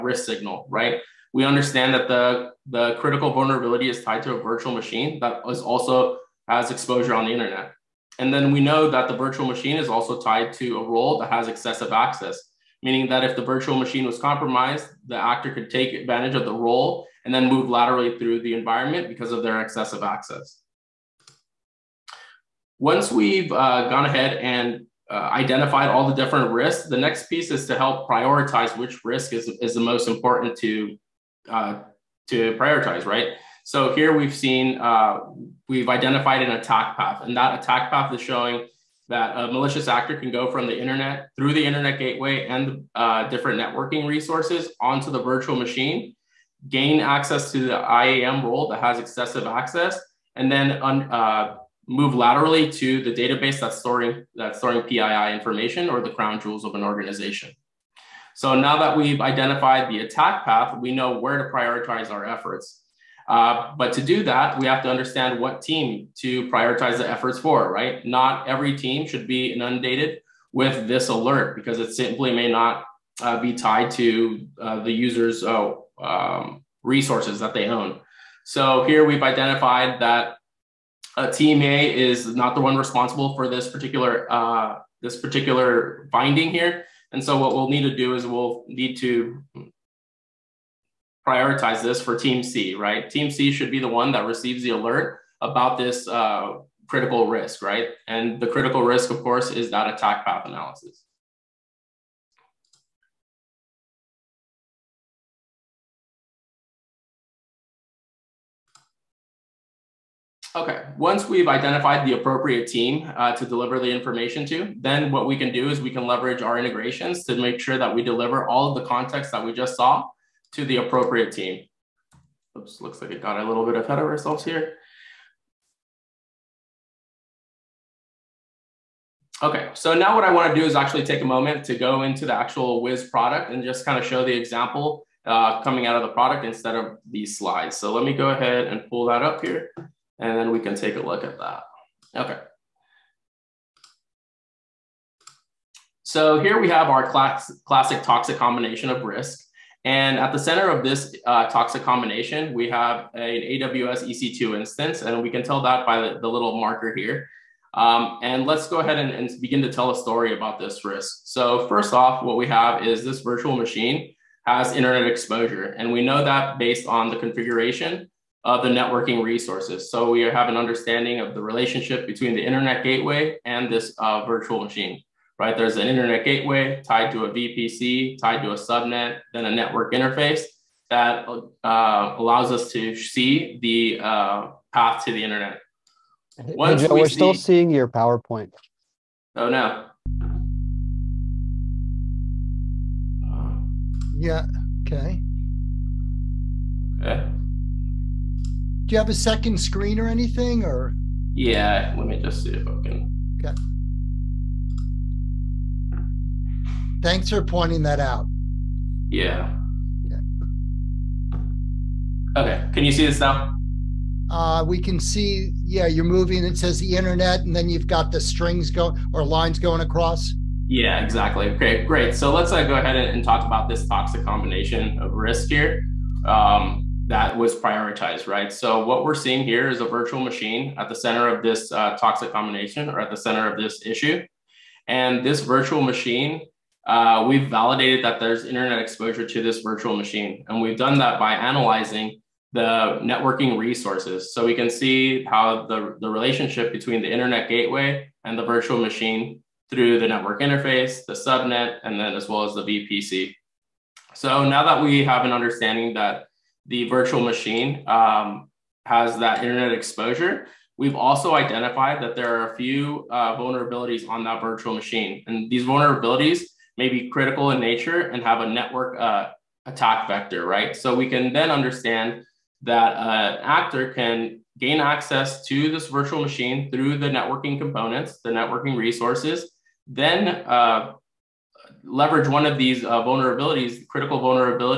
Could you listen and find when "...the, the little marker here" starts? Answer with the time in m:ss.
2:36.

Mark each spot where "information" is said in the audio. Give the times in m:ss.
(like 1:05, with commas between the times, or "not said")
0:55, 1:53.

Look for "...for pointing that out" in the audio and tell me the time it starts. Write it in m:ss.
3:27.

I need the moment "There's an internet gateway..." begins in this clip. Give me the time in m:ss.
2:55.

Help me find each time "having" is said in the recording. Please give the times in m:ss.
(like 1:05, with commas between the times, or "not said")
not said.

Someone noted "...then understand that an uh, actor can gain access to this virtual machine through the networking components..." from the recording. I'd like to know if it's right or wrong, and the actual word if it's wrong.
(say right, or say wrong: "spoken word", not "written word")
right.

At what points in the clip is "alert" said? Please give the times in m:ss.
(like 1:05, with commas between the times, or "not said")
1:11, 1:34.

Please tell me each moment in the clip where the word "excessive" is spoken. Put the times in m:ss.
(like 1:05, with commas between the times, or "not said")
0:11, 0:19, 0:49.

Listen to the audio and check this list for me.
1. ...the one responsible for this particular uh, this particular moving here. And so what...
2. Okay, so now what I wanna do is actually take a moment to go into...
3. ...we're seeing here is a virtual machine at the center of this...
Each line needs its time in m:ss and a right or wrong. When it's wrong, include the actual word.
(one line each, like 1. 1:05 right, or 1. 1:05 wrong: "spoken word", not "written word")
1. 1:22 wrong: "finding", not "moving"
2. 2:09 right
3. 3:49 right.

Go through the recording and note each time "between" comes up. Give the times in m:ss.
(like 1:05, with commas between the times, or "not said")
2:52, 4:06.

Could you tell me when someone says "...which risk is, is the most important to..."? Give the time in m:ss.
0:28.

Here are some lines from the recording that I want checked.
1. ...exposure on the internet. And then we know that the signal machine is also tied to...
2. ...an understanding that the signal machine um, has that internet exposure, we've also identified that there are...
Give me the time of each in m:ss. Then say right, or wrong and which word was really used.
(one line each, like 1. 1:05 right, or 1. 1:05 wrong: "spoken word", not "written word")
1. 0:06 wrong: "virtual", not "signal"
2. 4:15 wrong: "virtual", not "signal".